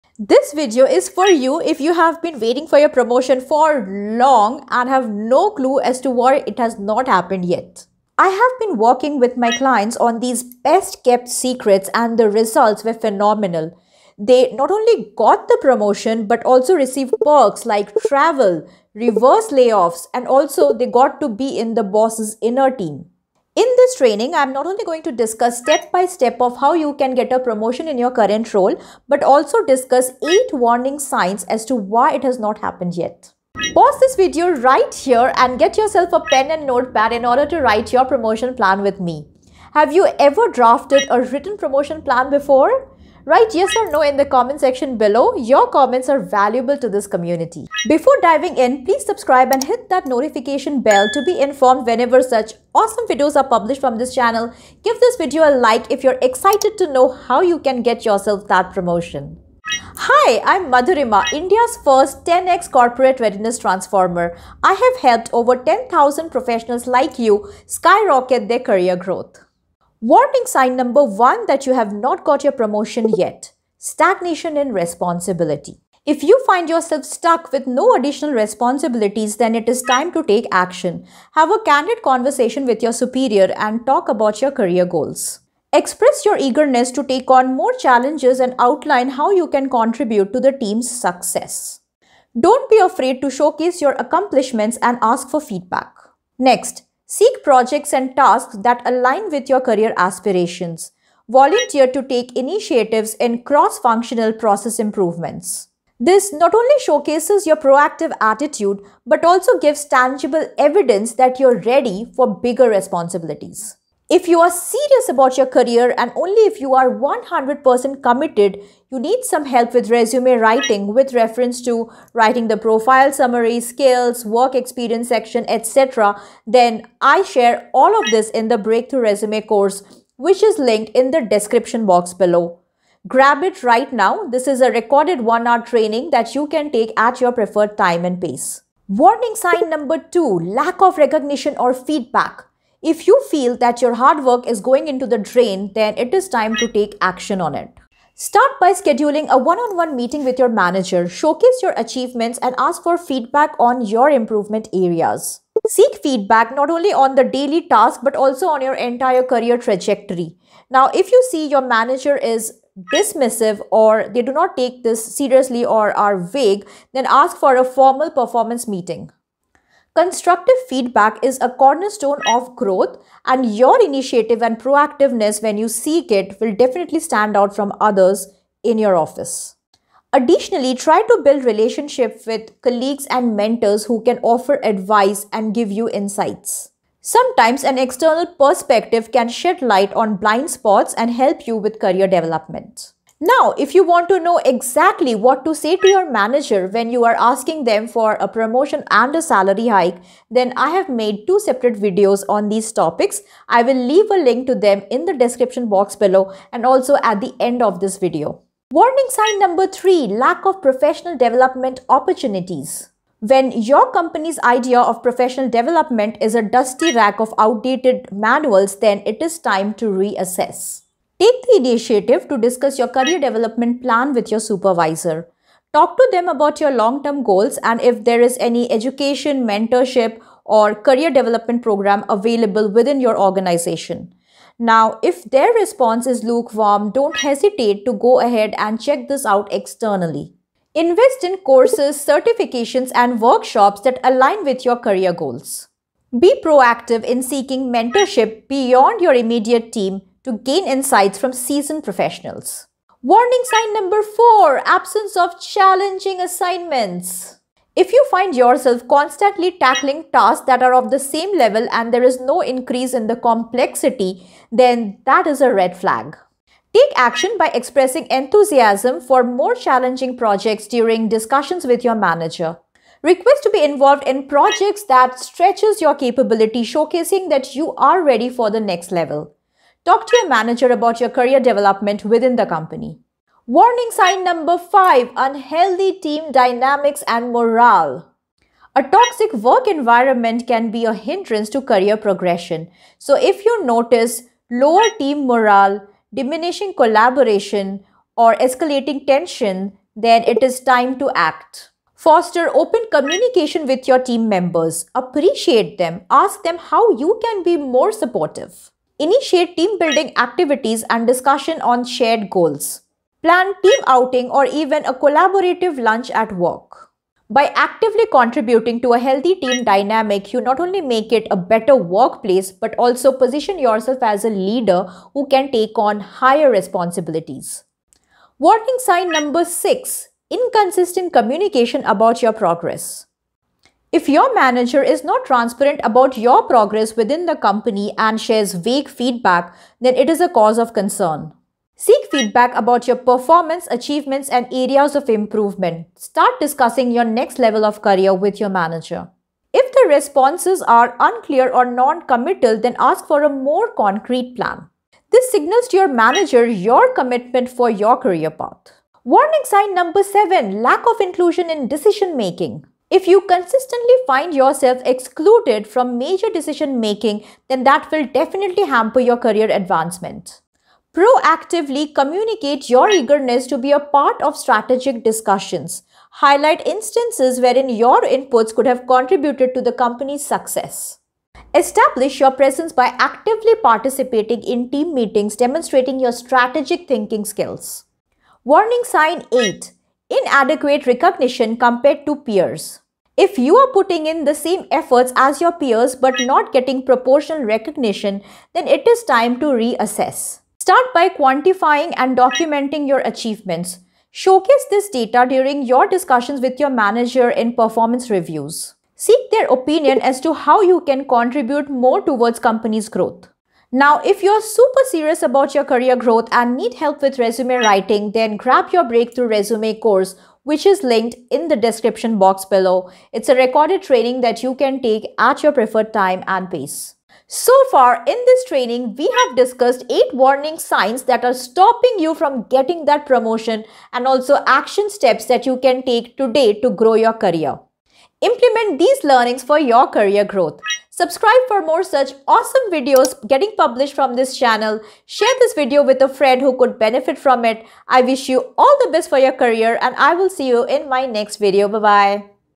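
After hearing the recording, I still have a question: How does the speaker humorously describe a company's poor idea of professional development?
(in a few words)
dusty rack of outdated manuals.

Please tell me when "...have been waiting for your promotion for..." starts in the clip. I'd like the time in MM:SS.
00:01.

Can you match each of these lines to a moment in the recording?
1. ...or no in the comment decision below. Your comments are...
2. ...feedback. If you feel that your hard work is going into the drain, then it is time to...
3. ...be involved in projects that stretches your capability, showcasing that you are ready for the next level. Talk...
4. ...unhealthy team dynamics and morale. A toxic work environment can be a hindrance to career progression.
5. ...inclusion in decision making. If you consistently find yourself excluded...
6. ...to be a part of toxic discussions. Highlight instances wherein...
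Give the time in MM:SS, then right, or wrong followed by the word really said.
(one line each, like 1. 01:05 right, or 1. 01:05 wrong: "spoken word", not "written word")
1. 00:43 wrong: "section", not "decision"
2. 02:21 right
3. 04:33 right
4. 04:45 right
5. 06:01 right
6. 06:13 wrong: "strategic", not "toxic".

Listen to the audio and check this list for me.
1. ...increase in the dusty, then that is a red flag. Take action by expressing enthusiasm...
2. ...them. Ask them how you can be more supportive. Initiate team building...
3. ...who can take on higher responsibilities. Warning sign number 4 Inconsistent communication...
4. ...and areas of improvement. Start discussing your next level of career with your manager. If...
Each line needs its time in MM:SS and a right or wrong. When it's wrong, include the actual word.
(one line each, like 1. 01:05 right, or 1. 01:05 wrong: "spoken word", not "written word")
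1. 04:22 wrong: "complexity", not "dusty"
2. 05:05 right
3. 05:25 wrong: "6", not "4"
4. 05:44 right.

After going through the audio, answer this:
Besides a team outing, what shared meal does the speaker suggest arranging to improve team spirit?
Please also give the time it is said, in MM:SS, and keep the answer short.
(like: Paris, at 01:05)
collaborative lunch, at 05:14.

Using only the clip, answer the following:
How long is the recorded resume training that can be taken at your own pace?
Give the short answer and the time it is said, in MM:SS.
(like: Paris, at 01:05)
one hour, at 02:15.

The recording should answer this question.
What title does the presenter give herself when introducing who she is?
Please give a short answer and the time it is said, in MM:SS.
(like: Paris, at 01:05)
India's first 10x corporate readiness transformer, at 01:01.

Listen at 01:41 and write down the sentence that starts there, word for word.
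Volunteer to take initiatives in cross-functional process improvements.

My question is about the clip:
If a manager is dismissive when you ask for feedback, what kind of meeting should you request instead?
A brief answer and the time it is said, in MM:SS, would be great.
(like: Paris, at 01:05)
formal performance meeting, at 02:47.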